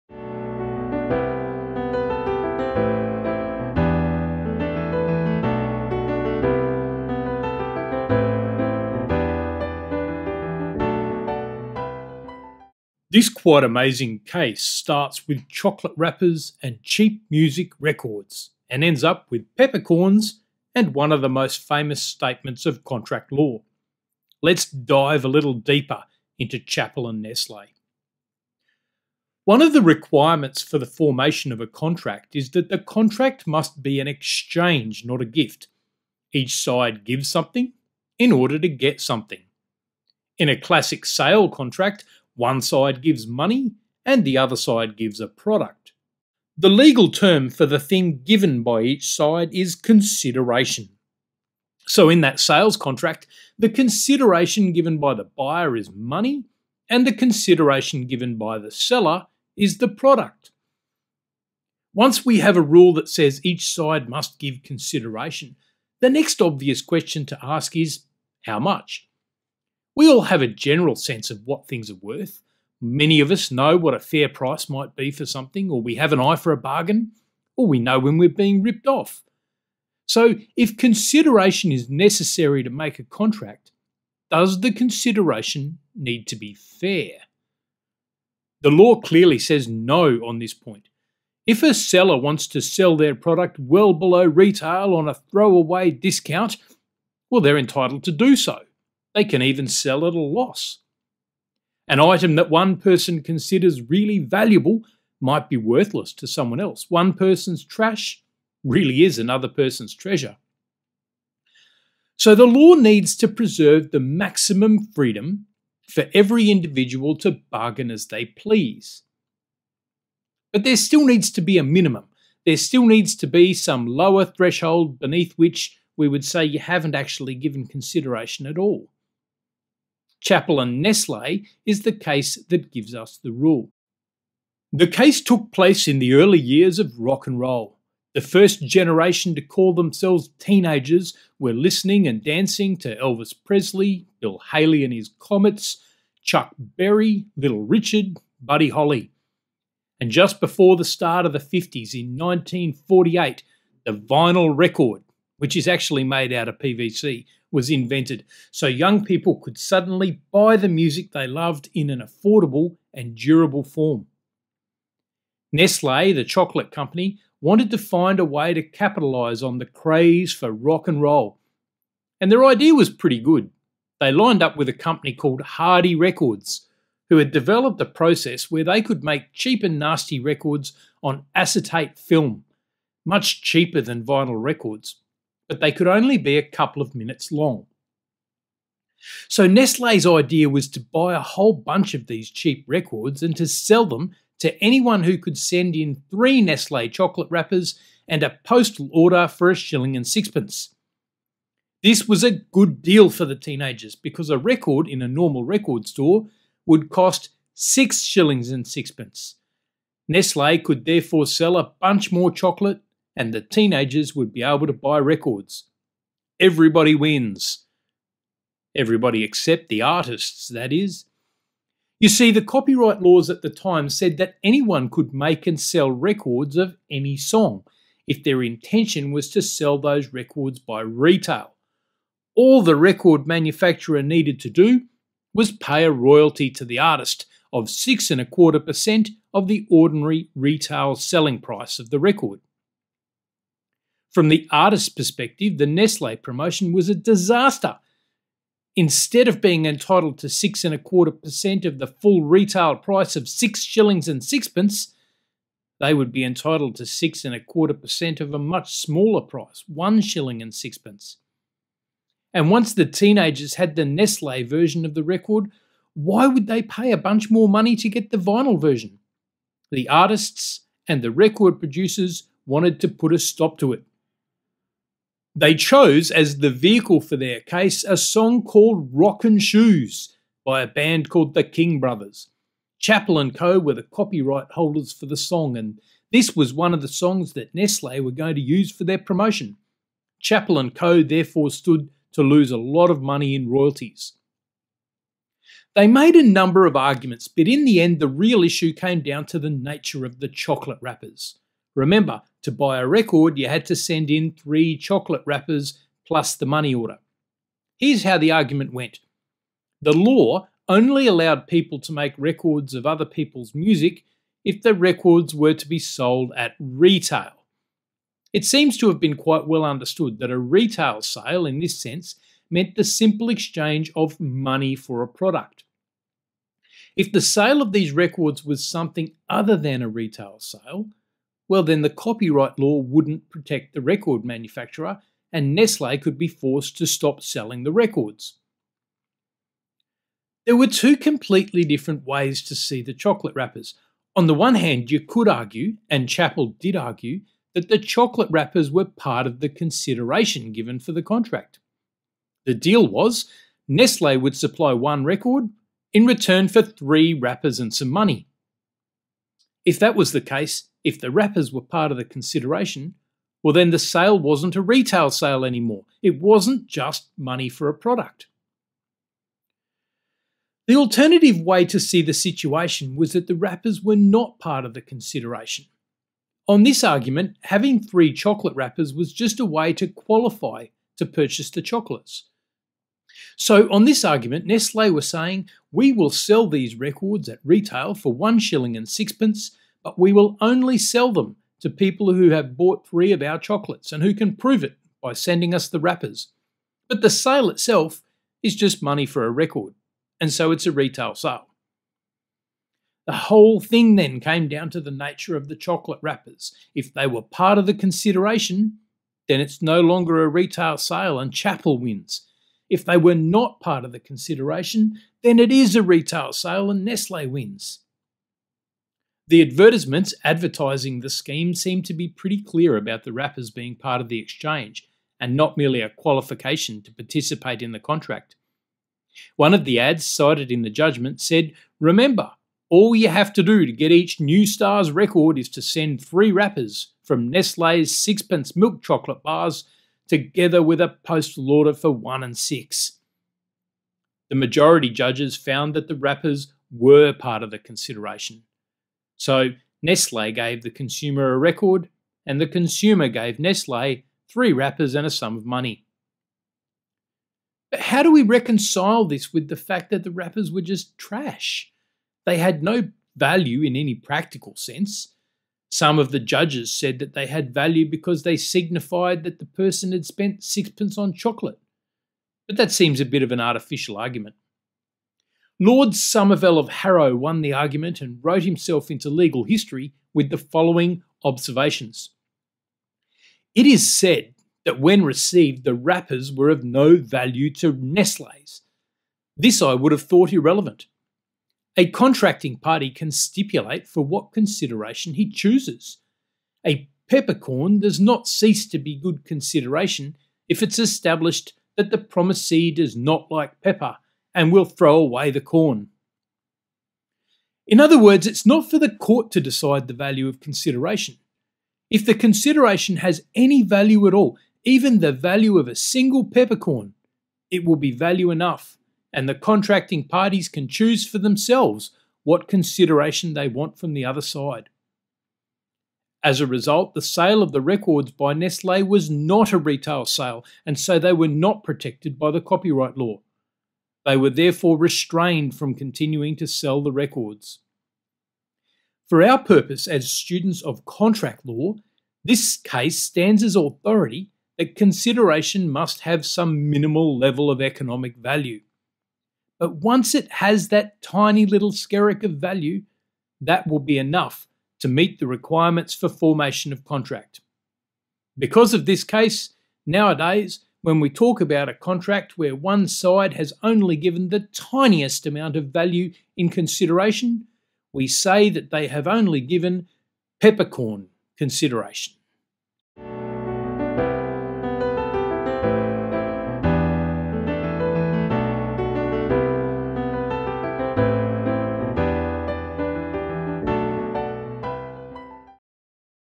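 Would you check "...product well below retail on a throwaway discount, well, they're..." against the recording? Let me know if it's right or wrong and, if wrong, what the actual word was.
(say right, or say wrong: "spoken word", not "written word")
right.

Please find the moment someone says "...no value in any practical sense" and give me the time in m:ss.
7:42.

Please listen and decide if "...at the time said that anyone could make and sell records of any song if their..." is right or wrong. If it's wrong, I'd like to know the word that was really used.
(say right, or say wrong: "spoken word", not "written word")
right.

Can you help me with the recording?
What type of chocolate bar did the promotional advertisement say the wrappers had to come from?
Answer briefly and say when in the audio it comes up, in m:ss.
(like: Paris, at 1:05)
Sixpence Milk Chocolate Bars, at 7:17.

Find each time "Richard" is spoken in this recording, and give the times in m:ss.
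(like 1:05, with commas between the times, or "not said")
2:27.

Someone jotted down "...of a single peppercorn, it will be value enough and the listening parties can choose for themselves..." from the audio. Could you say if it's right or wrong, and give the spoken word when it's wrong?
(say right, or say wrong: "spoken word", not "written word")
wrong: "contracting", not "listening".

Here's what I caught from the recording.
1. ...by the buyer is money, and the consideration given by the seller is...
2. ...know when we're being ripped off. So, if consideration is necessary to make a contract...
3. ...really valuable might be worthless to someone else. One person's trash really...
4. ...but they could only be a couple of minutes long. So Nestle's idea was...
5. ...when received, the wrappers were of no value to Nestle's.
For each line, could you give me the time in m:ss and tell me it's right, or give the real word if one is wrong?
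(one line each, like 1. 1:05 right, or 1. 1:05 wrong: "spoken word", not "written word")
1. 0:54 right
2. 1:17 right
3. 1:43 right
4. 3:05 right
5. 8:04 right.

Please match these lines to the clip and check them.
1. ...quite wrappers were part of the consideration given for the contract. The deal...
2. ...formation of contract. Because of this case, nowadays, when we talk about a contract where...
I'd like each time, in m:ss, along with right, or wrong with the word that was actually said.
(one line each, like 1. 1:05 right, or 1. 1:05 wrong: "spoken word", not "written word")
1. 5:47 wrong: "chocolate", not "quite"
2. 9:16 right.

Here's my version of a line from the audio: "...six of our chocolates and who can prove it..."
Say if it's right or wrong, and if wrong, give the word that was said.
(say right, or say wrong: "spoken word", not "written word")
wrong: "three", not "six".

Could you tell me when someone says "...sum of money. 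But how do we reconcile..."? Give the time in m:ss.
7:35.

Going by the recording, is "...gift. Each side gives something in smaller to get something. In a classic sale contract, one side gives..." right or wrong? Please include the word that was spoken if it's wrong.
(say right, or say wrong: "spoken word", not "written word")
wrong: "order", not "smaller".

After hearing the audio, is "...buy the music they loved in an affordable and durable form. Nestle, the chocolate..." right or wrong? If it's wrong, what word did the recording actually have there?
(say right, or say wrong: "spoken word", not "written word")
right.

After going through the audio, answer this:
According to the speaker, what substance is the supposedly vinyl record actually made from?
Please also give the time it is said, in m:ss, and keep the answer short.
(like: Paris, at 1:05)
PVC, at 2:36.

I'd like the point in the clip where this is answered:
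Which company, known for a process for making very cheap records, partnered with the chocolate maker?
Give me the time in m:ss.
2:55.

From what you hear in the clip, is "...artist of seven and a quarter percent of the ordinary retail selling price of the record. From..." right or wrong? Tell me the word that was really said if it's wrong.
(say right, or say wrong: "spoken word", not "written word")
wrong: "six", not "seven".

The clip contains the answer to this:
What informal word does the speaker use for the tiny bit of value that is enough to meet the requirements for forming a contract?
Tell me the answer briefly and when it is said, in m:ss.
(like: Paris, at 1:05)
Skerrick, at 9:11.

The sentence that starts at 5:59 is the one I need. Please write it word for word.
If that was the case, if the wrappers were part of the consideration, well, then the sale wasn't a retail sale anymore.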